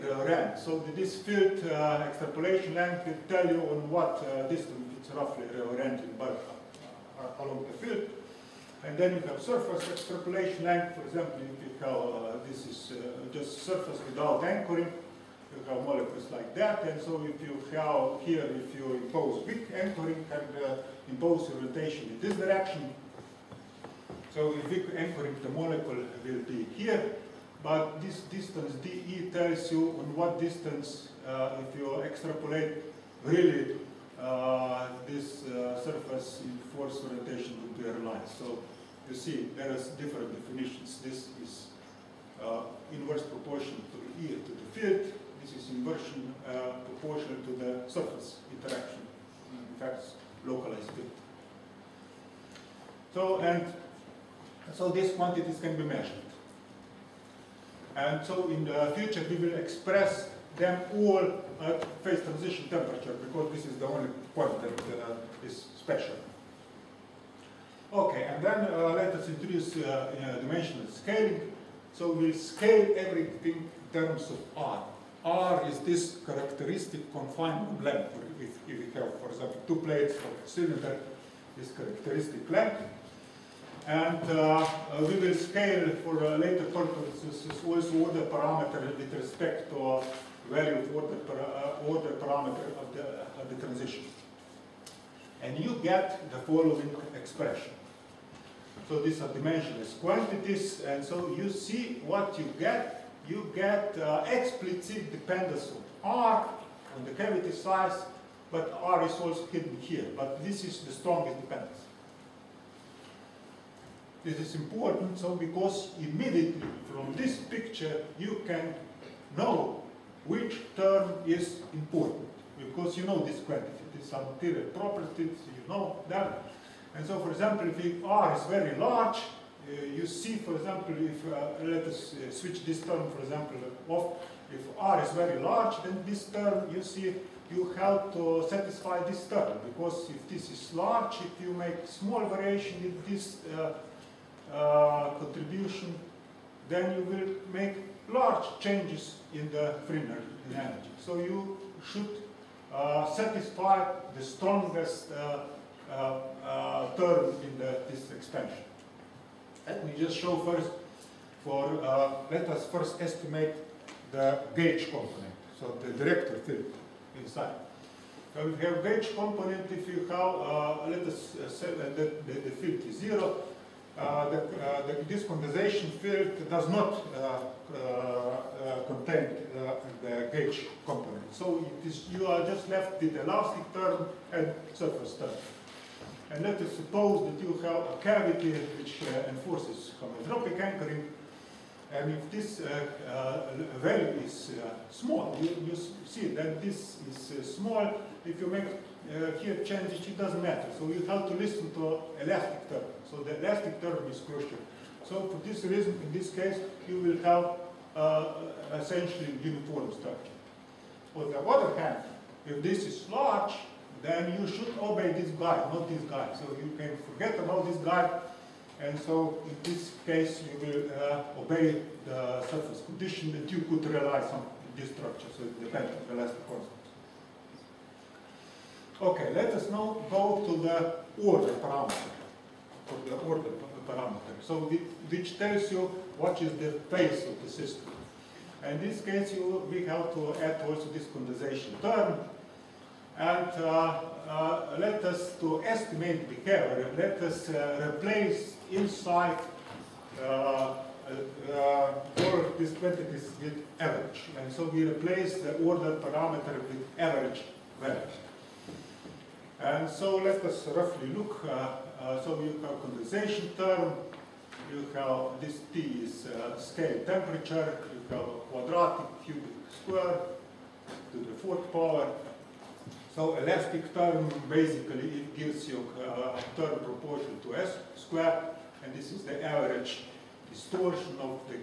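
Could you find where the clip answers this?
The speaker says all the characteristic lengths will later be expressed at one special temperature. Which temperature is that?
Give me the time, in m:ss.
1:02.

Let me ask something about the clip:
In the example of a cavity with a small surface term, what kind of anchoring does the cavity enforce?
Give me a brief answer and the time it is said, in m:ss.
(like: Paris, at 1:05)
Homeotropic anchoring, at 3:09.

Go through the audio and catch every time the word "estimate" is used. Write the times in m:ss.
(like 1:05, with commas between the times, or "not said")
2:42, 4:05.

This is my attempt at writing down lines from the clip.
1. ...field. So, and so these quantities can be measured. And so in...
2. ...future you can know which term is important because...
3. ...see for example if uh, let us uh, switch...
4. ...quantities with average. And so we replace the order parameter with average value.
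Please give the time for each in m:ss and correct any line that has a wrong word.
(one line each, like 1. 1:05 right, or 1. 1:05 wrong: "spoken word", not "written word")
1. 0:50 right
2. 1:57 wrong: "picture", not "future"
3. 2:10 right
4. 4:12 right.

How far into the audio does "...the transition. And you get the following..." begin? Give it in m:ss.
1:33.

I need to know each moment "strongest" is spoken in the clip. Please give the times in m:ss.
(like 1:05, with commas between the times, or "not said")
1:50, 2:34.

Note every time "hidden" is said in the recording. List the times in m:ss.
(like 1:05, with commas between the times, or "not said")
1:49.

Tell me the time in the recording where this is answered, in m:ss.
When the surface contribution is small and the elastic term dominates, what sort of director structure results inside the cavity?
3:28.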